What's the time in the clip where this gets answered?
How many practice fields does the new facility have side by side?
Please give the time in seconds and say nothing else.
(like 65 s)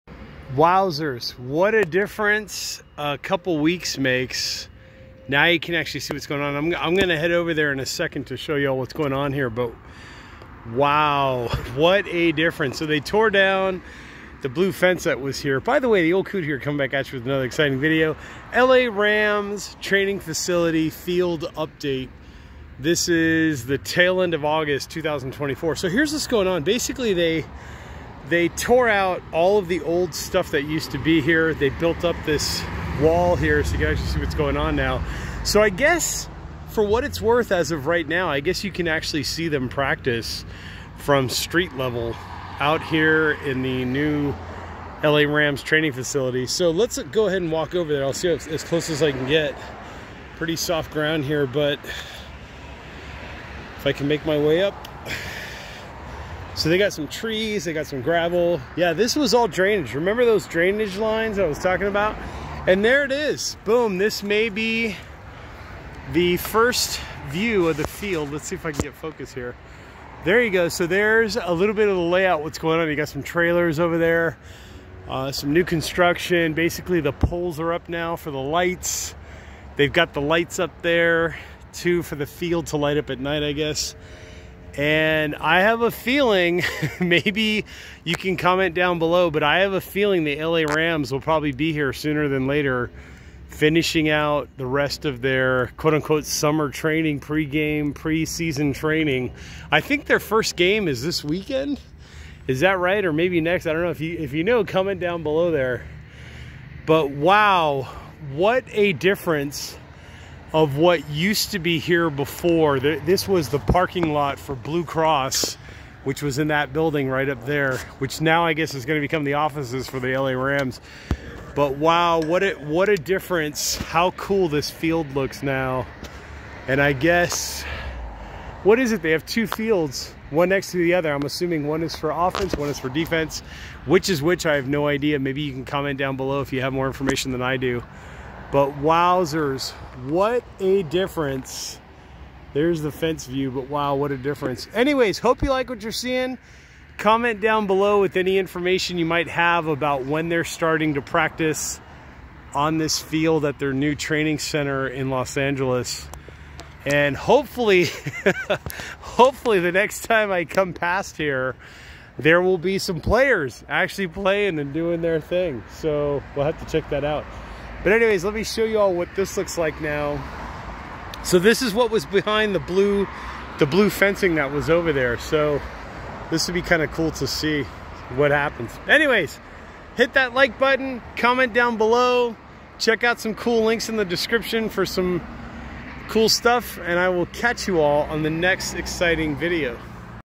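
129 s.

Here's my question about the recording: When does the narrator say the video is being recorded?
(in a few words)
Late August 2024.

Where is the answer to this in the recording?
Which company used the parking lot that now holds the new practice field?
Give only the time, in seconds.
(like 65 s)
114 s.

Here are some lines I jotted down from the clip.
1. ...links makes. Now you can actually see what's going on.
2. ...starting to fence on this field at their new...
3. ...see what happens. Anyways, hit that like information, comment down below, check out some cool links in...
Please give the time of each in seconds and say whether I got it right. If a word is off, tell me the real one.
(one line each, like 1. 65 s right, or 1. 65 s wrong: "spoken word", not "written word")
1. 3 s wrong: "weeks", not "links"
2. 150 s wrong: "practice", not "fence"
3. 177 s wrong: "button", not "information".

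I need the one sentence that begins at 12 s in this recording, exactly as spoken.
So they tore down the blue fence that was here.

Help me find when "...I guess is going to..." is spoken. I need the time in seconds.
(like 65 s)
118 s.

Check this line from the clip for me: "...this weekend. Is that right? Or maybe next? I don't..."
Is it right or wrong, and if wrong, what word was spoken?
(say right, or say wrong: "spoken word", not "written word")
right.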